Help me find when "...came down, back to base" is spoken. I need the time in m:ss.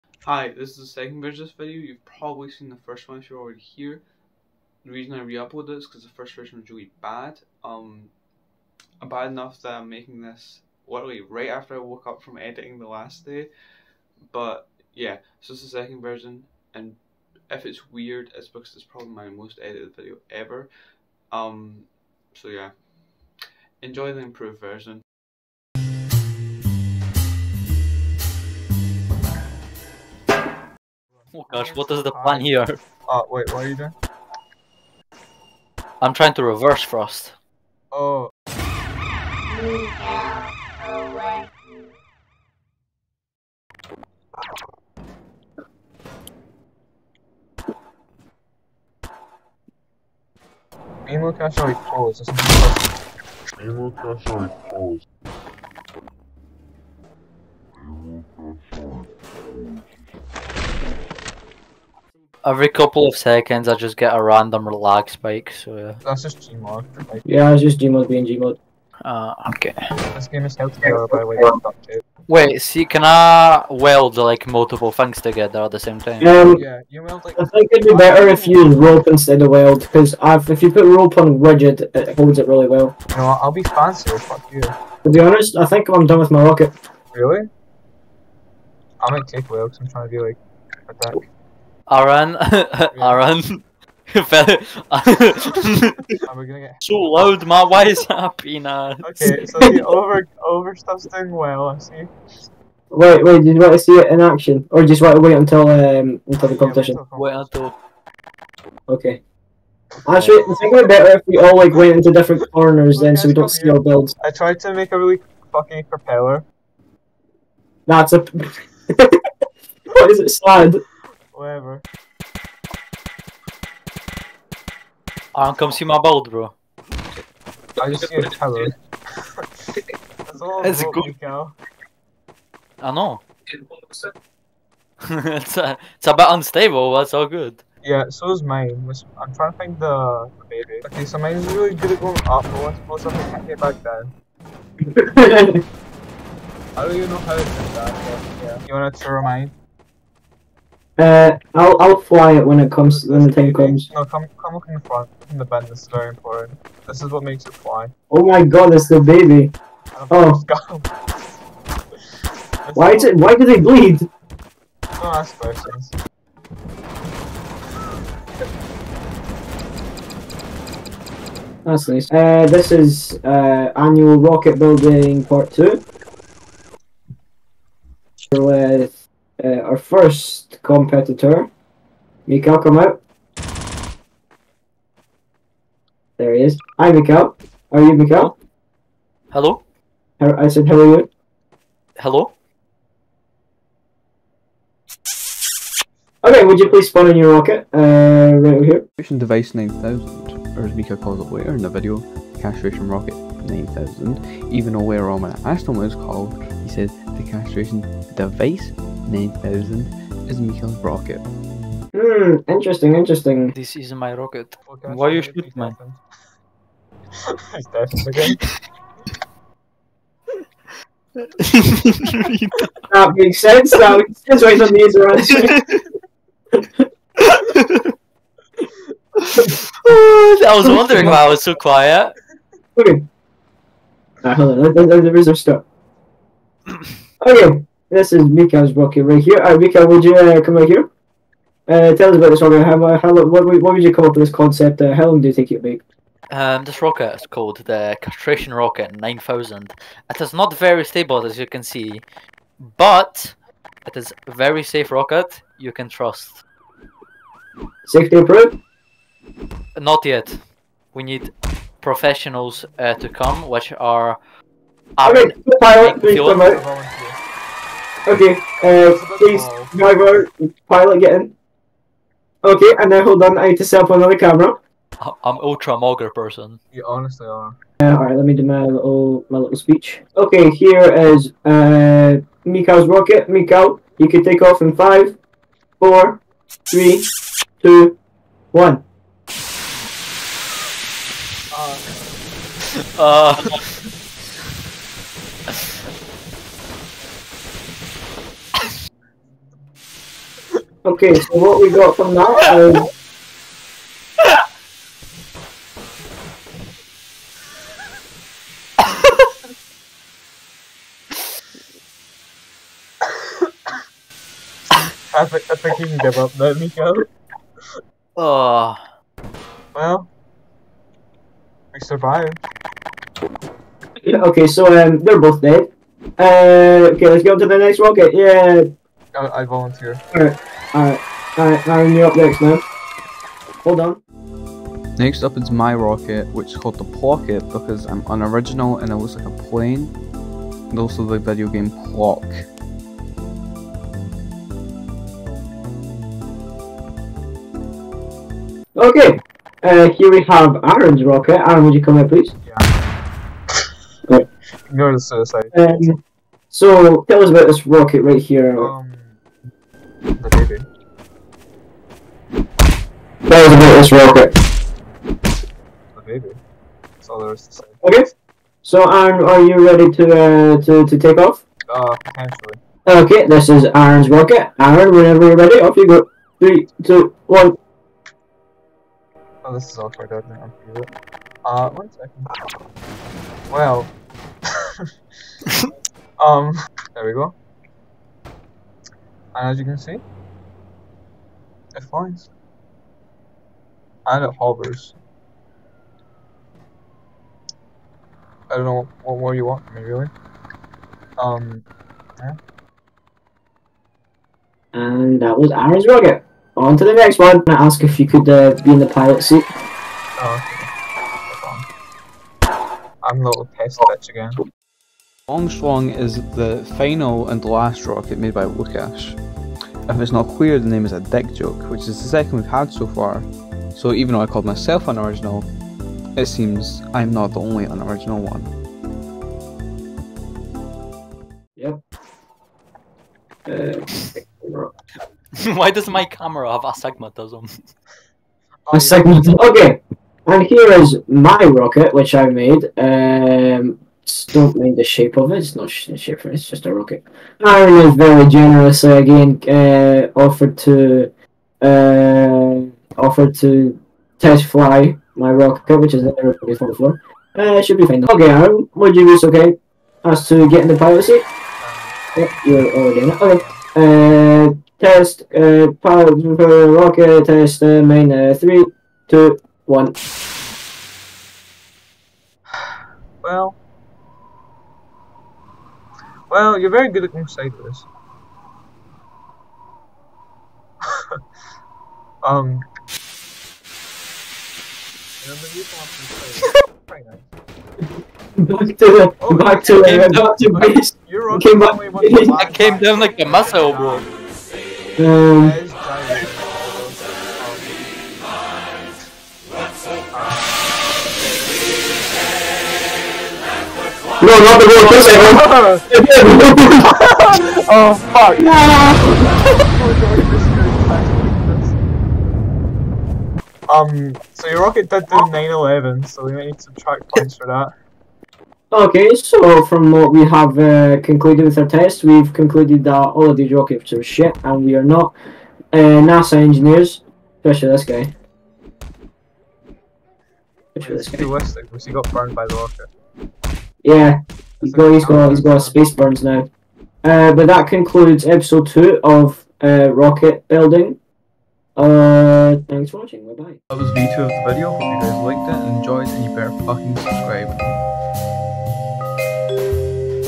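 8:09.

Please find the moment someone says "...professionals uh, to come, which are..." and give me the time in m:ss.
4:21.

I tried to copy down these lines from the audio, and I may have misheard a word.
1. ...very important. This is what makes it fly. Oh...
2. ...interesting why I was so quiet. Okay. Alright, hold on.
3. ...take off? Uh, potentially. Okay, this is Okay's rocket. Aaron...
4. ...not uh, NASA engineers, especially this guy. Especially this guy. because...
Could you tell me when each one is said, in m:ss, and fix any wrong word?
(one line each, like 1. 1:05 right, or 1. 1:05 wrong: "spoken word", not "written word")
1. 2:35 right
2. 3:50 wrong: "wondering", not "interesting"
3. 6:10 wrong: "Aaron", not "Okay"
4. 8:44 right.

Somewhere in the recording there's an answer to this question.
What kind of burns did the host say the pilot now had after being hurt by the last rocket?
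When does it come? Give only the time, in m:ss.
8:55.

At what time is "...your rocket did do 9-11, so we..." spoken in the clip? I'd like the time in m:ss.
8:34.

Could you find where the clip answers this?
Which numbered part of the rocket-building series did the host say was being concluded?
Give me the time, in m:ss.
8:58.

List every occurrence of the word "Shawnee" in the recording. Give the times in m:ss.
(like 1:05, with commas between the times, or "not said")
not said.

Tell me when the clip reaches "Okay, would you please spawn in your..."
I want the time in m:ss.
3:16.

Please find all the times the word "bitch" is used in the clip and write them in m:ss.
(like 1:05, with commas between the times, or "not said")
6:53.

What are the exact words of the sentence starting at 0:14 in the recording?
But yeah, so it's the second version, and if it's weird, it's because it's probably my most edited video ever.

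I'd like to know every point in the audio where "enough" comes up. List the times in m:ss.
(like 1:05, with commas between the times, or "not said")
0:09.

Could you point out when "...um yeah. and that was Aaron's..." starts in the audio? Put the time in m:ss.
6:41.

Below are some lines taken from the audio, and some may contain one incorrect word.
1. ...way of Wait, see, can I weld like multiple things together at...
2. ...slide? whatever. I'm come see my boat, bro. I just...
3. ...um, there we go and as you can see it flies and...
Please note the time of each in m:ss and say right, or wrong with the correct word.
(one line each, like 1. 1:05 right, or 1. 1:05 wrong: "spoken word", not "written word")
1. 1:11 right
2. 2:00 right
3. 6:26 right.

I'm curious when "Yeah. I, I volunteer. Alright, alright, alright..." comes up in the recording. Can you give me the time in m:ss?
5:28.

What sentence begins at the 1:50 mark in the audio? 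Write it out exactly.
Actually I think it'd be better if we all like went into different corners then so we don't see our builds.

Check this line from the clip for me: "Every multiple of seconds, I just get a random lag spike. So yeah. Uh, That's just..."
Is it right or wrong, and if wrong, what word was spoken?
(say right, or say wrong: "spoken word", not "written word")
wrong: "couple", not "multiple".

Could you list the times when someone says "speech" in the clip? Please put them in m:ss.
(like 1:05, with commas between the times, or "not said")
4:39.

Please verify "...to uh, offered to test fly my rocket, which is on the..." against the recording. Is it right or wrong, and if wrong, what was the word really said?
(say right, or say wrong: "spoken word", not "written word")
right.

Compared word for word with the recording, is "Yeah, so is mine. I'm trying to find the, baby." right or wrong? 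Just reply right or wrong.
right.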